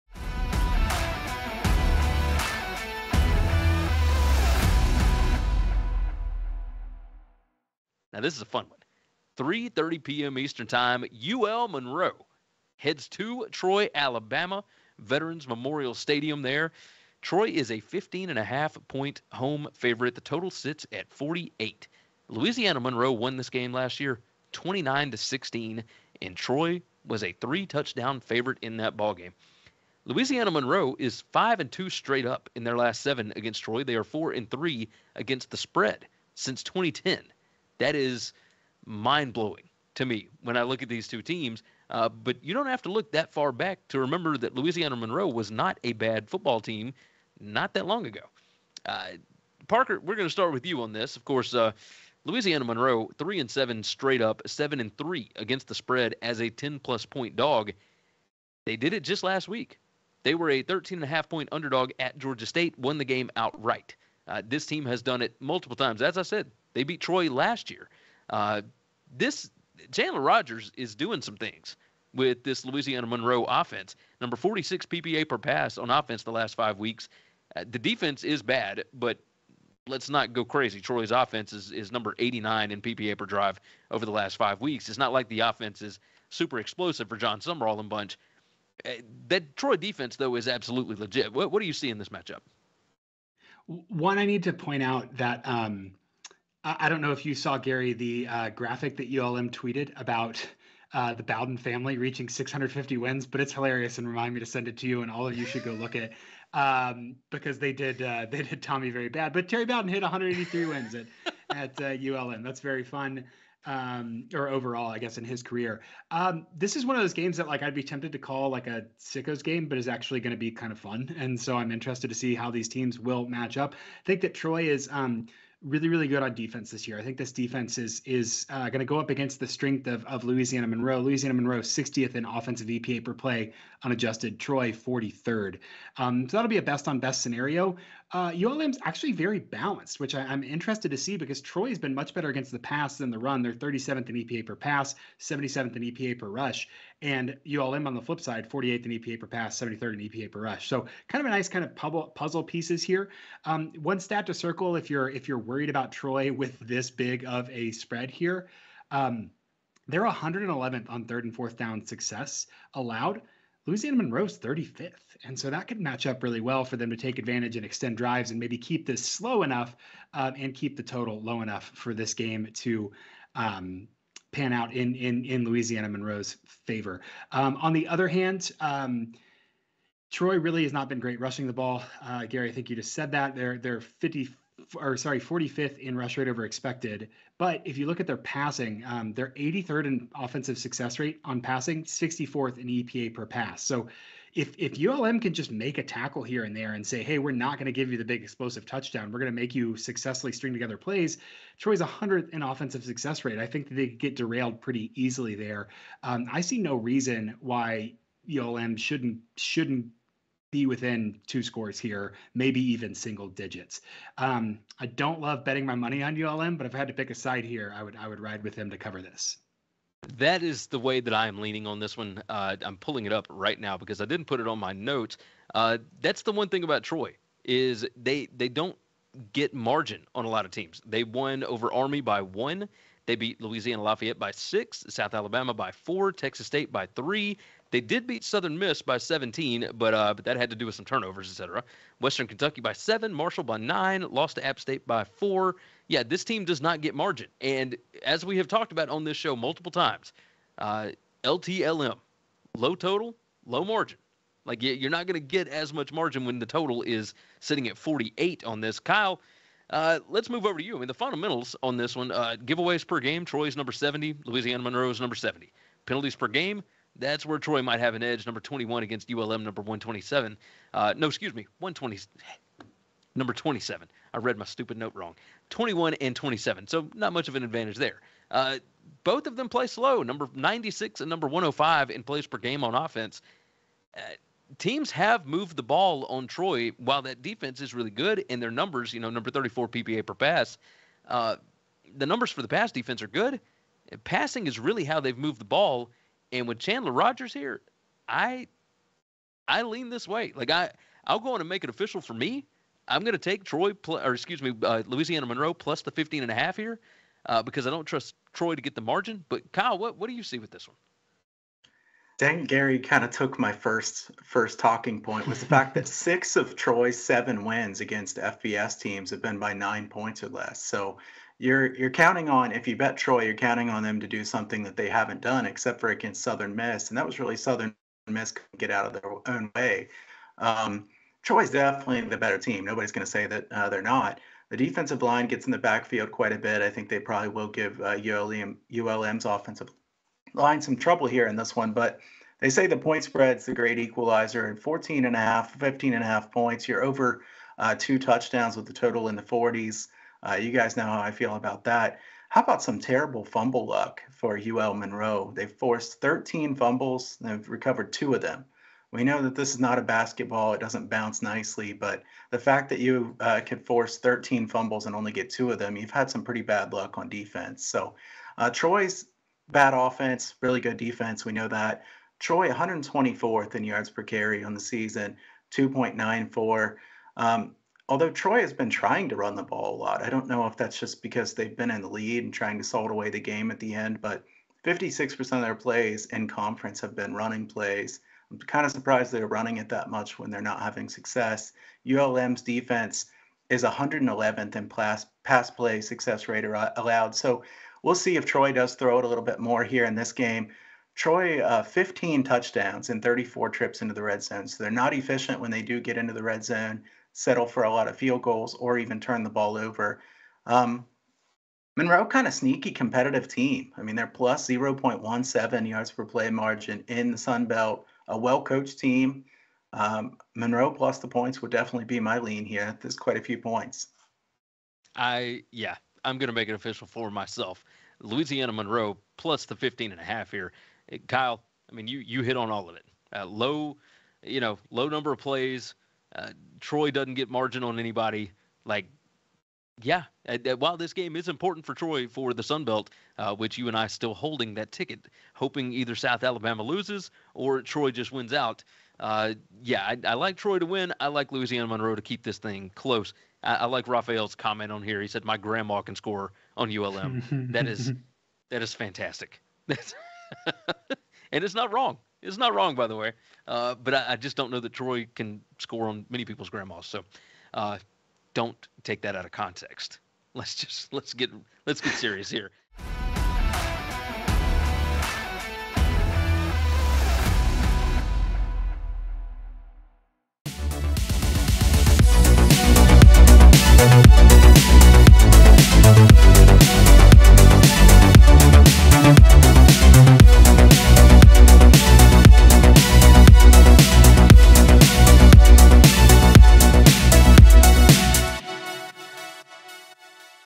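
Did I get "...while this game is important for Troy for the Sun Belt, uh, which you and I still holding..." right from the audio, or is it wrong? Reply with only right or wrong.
right.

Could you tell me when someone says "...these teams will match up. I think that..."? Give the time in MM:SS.
02:02.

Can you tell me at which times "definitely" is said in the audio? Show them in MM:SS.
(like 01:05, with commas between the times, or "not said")
05:31, 07:01.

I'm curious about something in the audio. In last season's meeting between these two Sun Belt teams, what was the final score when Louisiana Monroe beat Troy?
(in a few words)
29-16.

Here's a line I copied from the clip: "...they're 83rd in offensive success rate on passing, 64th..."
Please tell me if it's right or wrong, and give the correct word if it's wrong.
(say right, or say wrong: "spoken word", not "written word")
right.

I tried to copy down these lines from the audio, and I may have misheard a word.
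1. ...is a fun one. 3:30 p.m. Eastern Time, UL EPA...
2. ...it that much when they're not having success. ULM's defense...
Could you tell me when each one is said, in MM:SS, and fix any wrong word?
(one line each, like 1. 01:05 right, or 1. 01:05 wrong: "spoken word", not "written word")
1. 00:08 wrong: "Monroe", not "EPA"
2. 06:29 right.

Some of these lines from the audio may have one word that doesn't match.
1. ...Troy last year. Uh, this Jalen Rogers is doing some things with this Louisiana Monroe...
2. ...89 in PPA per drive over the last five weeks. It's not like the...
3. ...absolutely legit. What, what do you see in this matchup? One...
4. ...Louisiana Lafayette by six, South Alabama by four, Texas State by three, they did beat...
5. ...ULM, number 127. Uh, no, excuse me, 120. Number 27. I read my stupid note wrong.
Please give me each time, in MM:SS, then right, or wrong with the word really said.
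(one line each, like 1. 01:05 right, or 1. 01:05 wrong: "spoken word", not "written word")
1. 01:07 right
2. 01:22 right
3. 01:30 right
4. 03:53 right
5. 04:29 right.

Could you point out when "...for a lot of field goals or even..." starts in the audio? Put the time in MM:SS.
06:47.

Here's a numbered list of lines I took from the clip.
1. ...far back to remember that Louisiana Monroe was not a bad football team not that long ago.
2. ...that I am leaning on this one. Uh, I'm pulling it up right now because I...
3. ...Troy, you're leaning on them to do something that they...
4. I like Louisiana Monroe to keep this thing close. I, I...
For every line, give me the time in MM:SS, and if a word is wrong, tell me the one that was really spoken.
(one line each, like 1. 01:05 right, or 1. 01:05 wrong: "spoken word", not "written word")
1. 00:43 right
2. 03:40 right
3. 05:22 wrong: "counting", not "leaning"
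4. 07:30 right.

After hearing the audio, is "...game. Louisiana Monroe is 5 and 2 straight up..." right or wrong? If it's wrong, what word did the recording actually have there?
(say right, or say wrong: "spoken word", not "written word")
right.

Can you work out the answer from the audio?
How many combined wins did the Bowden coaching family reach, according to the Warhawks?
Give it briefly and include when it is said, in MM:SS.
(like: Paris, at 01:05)
650, at 01:42.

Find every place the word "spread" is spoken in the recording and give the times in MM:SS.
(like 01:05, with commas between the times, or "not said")
00:35, 00:55, 02:37, 05:43.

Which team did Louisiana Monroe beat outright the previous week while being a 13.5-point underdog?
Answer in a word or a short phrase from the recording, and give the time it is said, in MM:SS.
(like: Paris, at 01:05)
Georgia State, at 01:02.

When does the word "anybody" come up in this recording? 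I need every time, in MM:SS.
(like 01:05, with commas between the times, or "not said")
07:17.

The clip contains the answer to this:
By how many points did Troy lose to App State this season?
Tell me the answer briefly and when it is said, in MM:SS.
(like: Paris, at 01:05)
4, at 04:04.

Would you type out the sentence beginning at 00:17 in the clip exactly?
Troy is a 15 and a half point home favorite.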